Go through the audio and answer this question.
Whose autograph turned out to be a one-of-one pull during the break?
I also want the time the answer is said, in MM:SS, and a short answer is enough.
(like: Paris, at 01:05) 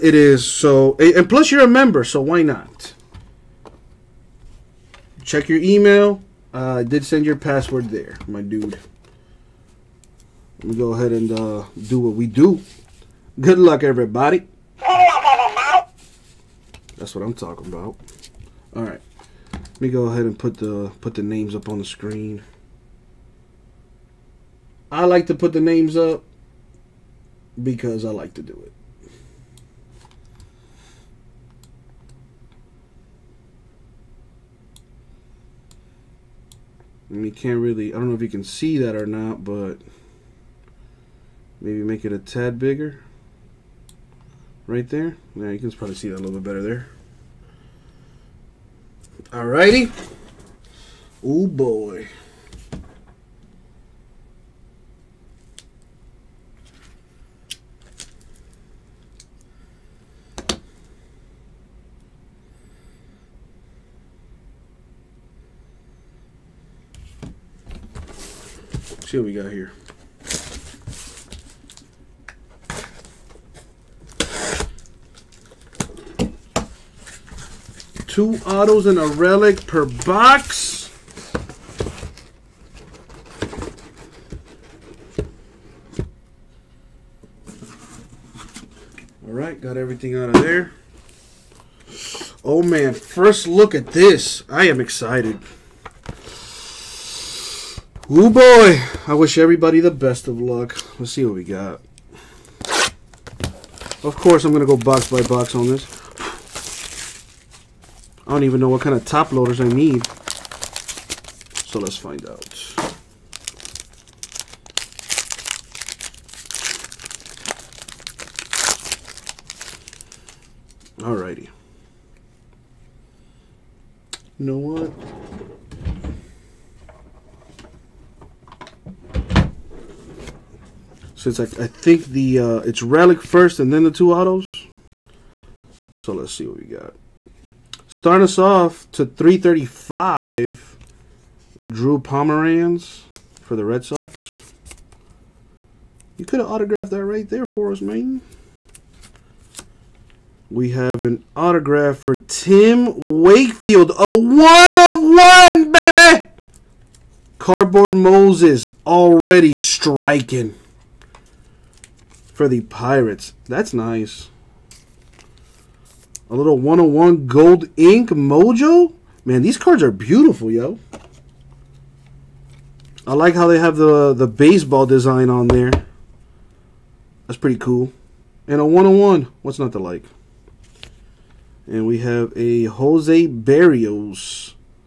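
Tim Wakefield, at 02:32.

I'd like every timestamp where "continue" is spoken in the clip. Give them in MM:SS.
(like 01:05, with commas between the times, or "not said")
not said.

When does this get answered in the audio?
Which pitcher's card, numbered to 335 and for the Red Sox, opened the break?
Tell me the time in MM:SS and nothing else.
02:21.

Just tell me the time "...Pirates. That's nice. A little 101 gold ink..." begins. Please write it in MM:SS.
02:42.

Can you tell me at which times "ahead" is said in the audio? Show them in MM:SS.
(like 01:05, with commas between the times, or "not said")
00:10, 00:20.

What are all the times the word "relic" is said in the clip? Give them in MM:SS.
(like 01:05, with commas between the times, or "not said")
01:19, 02:12.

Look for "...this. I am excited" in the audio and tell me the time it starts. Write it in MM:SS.
01:33.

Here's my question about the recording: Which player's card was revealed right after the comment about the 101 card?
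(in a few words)
Jose Berrios.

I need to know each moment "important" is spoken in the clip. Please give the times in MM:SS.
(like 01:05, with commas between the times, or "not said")
not said.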